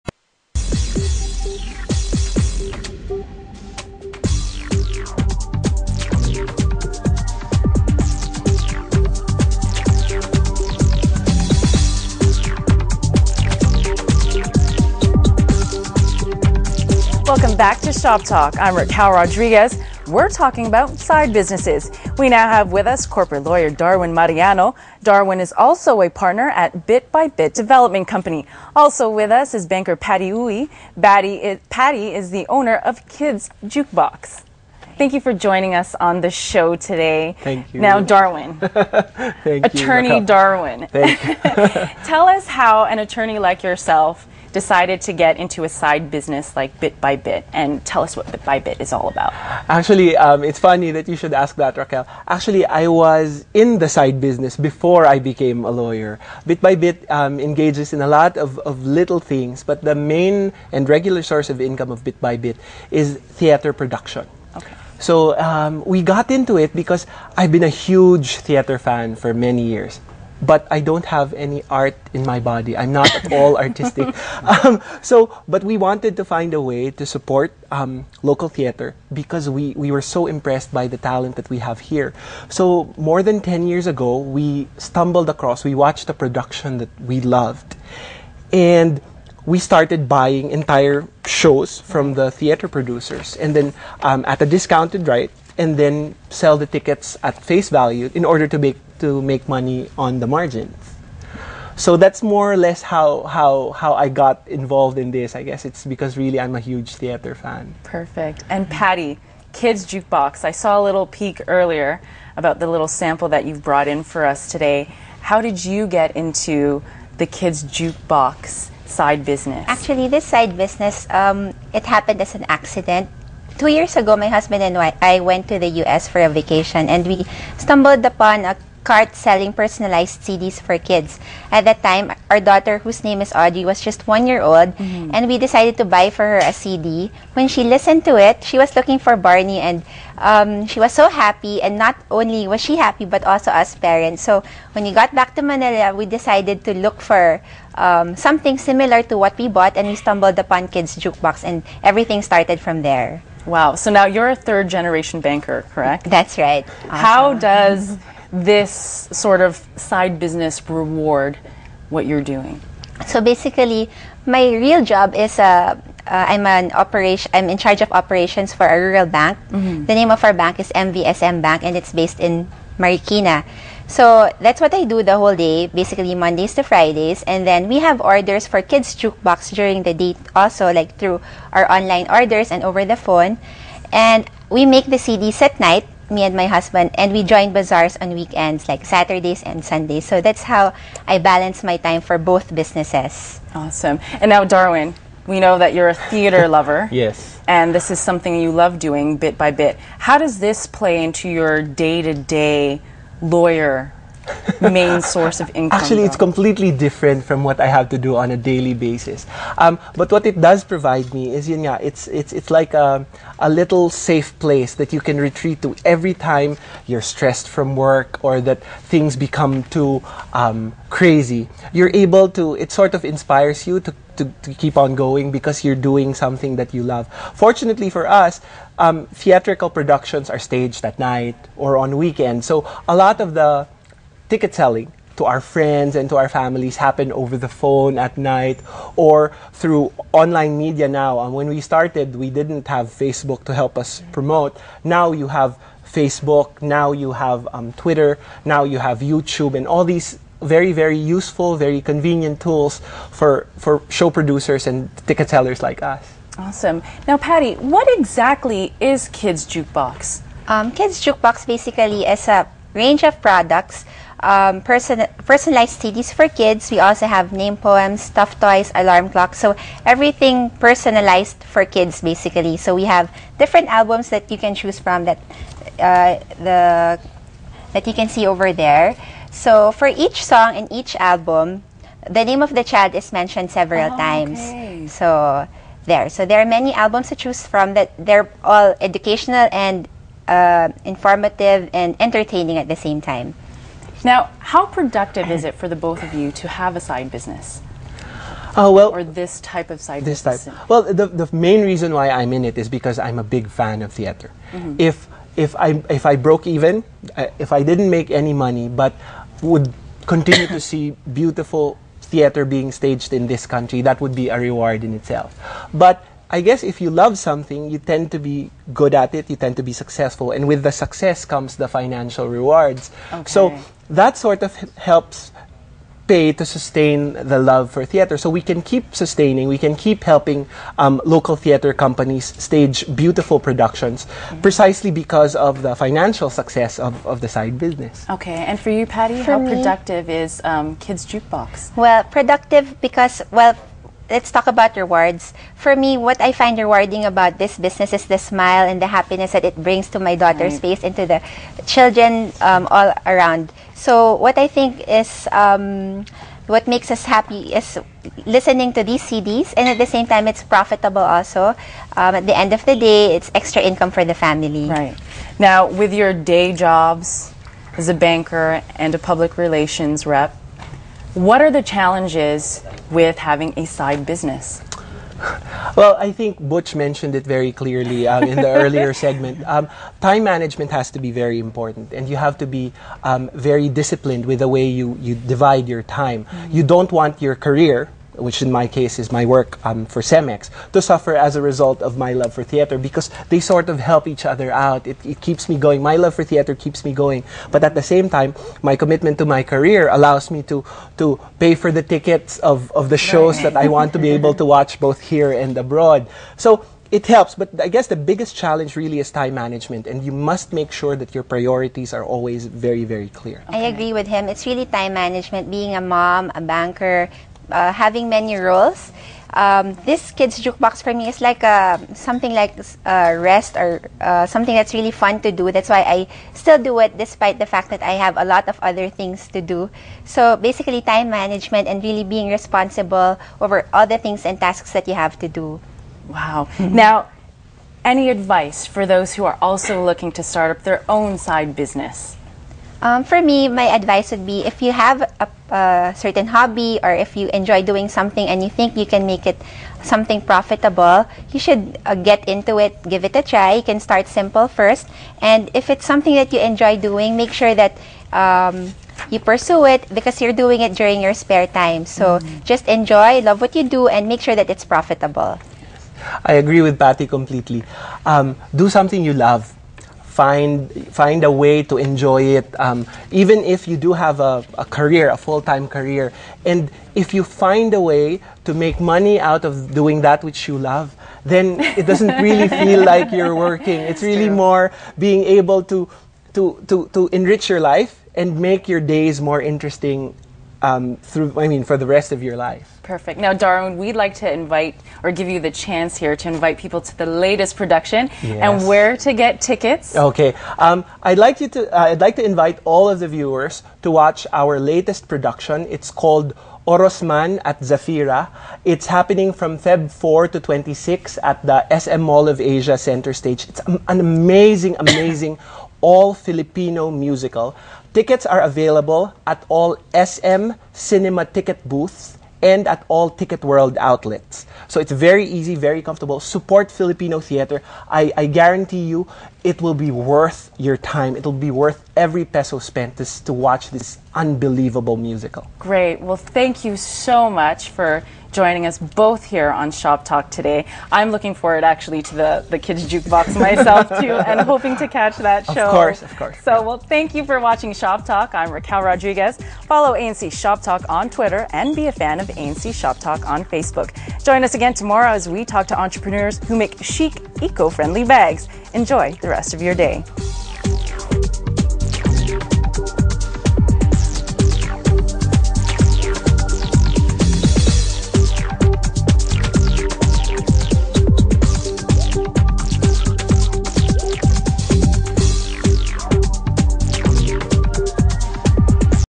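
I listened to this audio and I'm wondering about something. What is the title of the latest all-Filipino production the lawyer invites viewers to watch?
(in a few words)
Orosman at Zafira.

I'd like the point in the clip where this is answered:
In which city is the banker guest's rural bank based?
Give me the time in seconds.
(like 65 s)
172 s.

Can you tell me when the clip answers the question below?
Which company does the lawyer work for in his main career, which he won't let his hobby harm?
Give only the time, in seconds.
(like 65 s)
390 s.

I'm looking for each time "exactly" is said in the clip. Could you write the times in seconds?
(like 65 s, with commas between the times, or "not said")
257 s.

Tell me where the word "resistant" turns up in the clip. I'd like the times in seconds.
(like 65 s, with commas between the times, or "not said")
not said.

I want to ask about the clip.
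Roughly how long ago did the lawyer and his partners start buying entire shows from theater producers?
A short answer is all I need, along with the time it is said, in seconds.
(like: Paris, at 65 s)
More than 10 years, at 82 s.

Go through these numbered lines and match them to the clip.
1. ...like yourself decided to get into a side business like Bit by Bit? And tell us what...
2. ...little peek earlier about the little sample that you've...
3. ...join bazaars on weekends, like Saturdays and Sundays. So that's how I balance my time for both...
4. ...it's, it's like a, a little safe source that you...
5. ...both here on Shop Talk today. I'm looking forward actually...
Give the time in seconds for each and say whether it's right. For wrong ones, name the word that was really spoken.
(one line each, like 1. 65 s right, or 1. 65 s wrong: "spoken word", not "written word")
1. 43 s right
2. 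110 s right
3. 187 s right
4. 212 s wrong: "place", not "source"
5. 538 s right.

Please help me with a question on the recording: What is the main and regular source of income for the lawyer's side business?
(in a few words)
Theater production.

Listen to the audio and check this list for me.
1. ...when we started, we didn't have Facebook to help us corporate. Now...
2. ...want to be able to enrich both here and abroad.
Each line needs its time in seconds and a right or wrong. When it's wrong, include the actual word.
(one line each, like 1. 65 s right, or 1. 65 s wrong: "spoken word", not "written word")
1. 241 s wrong: "promote", not "corporate"
2. 403 s wrong: "watch", not "enrich".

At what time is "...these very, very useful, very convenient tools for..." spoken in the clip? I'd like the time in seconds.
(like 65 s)
249 s.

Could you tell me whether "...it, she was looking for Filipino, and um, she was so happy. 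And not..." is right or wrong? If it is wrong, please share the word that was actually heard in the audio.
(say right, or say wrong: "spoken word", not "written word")
wrong: "Barney", not "Filipino".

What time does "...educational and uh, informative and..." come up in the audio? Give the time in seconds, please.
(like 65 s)
288 s.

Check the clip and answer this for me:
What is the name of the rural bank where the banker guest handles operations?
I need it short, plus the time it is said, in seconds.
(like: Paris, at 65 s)
MVSM Bank, at 170 s.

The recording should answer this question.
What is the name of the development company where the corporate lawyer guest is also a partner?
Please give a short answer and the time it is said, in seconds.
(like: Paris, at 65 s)
Bit by Bit Development Company, at 26 s.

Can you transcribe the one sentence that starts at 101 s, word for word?
So that's more or less how, how, how I got involved in this.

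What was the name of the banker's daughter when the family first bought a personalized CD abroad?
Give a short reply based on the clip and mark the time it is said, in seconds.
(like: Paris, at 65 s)
Audrey, at 133 s.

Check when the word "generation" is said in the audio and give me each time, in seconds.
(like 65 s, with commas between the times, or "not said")
154 s.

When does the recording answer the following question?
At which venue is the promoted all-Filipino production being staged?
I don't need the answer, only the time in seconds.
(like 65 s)
511 s.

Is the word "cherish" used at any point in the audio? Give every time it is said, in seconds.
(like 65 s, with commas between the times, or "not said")
not said.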